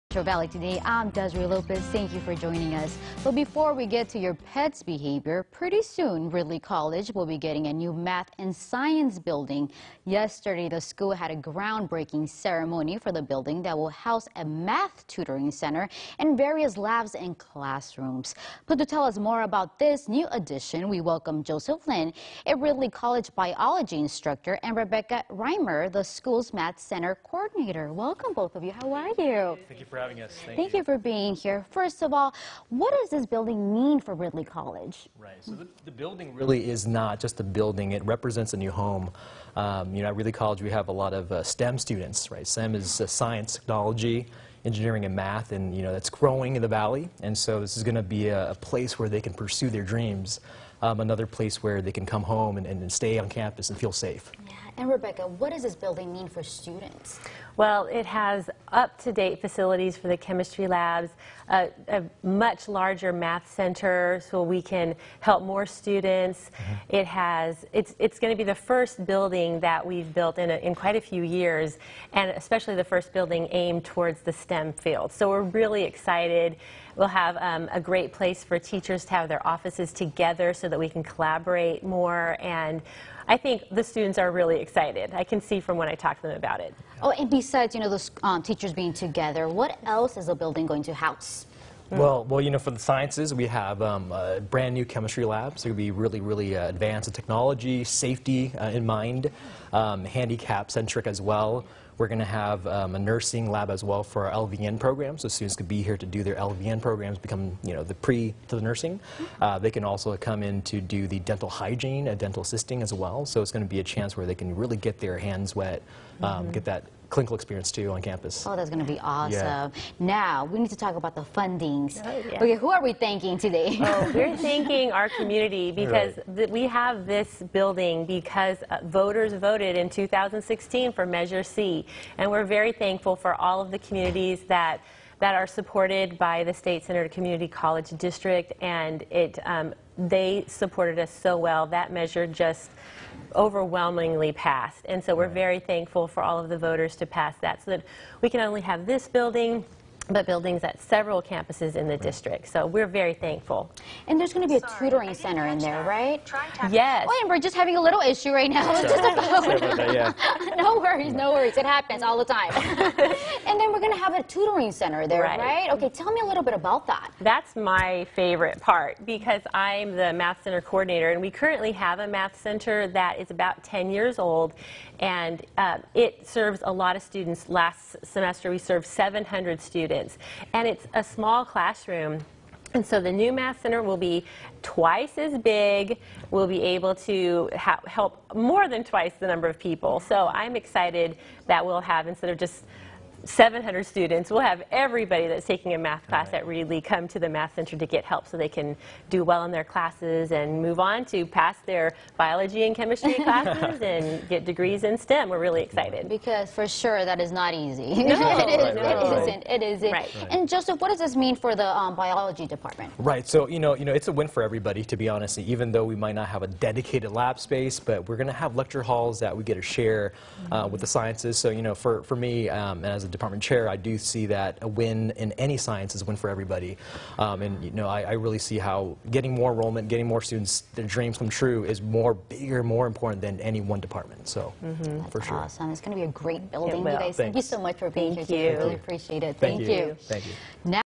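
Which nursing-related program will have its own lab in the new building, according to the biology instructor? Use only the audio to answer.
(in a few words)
LVN program.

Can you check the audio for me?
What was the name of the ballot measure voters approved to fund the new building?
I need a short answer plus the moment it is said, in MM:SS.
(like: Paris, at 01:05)
Measure C, at 02:11.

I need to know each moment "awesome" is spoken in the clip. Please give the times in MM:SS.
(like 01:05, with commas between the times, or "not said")
01:59, 03:55.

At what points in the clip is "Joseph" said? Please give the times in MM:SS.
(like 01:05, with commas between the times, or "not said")
00:21, 03:30.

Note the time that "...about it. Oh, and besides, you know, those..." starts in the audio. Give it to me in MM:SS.
01:26.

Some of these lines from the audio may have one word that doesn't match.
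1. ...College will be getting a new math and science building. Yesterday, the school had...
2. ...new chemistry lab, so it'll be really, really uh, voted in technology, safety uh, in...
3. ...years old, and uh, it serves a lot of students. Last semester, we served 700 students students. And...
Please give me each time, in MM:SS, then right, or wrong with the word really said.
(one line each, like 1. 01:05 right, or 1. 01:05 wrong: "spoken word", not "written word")
1. 00:06 right
2. 01:34 wrong: "advanced", not "voted"
3. 02:53 right.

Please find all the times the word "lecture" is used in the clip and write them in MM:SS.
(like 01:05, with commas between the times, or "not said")
03:38.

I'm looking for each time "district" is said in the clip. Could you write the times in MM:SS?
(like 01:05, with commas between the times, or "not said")
02:17, 02:31.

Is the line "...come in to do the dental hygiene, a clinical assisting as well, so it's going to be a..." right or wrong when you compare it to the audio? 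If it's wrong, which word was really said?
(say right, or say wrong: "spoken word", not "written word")
wrong: "dental", not "clinical".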